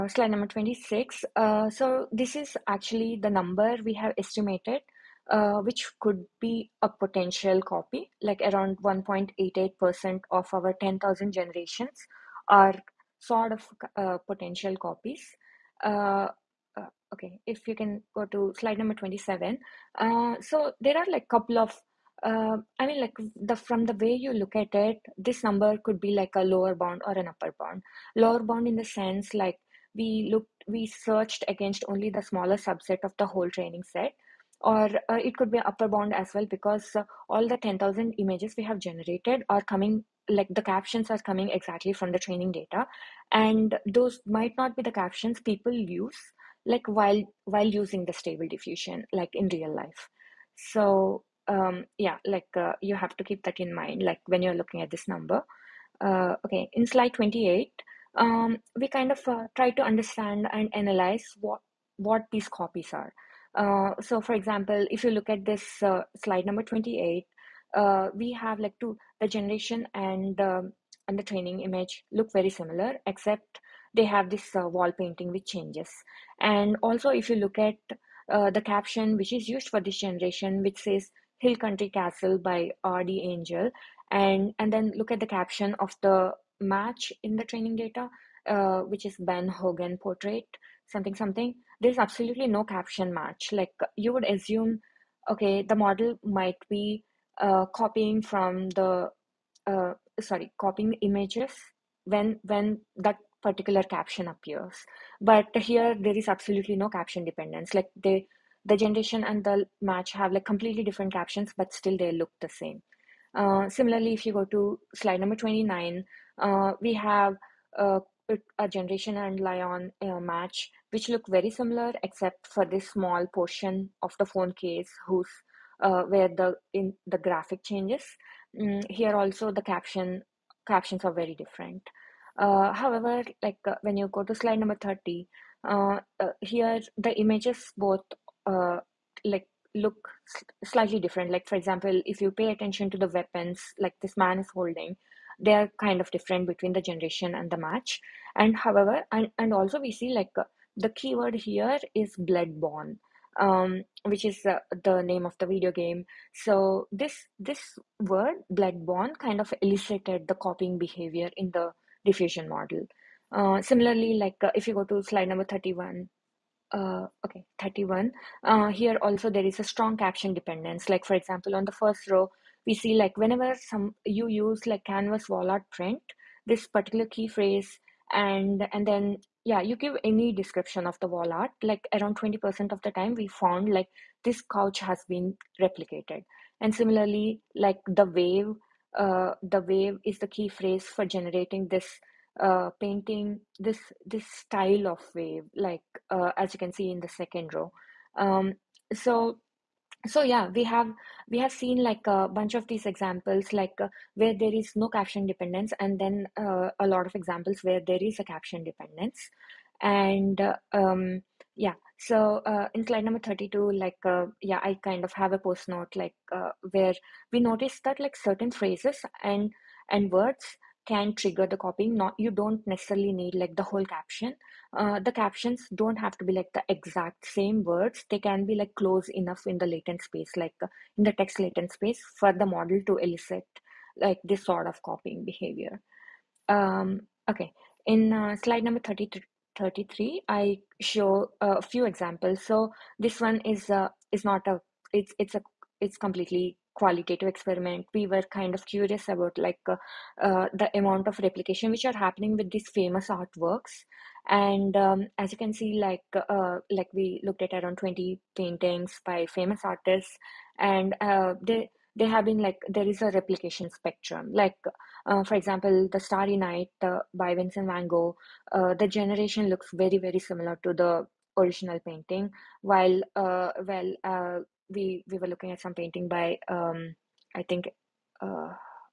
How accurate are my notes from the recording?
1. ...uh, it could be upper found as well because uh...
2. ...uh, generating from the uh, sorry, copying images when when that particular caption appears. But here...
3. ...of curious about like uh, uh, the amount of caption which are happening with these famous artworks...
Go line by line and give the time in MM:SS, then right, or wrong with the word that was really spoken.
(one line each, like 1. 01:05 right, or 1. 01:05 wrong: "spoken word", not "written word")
1. 00:35 wrong: "bound", not "found"
2. 01:37 wrong: "copying", not "generating"
3. 04:08 wrong: "replication", not "caption".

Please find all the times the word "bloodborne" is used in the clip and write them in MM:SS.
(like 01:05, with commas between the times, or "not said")
02:32, 02:38.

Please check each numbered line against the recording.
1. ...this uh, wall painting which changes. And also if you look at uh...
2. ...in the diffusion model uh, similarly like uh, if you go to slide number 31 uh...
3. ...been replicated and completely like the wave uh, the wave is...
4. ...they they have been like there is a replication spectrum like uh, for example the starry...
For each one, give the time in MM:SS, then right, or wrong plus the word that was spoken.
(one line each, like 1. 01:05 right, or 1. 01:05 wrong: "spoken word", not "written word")
1. 01:14 right
2. 02:41 right
3. 03:05 wrong: "similarly", not "completely"
4. 04:21 right.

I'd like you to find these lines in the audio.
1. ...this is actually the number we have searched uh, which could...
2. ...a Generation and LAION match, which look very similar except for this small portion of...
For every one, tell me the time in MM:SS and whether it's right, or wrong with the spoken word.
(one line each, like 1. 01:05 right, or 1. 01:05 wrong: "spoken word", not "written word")
1. 00:02 wrong: "estimated", not "searched"
2. 01:58 right.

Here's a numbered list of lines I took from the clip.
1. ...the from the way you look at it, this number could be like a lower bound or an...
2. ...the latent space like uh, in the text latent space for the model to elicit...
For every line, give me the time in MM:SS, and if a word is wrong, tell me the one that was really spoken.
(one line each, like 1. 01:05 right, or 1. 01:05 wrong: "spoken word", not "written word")
1. 00:23 right
2. 03:49 right.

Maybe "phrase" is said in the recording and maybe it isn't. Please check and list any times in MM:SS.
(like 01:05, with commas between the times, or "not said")
02:57, 03:10, 03:38.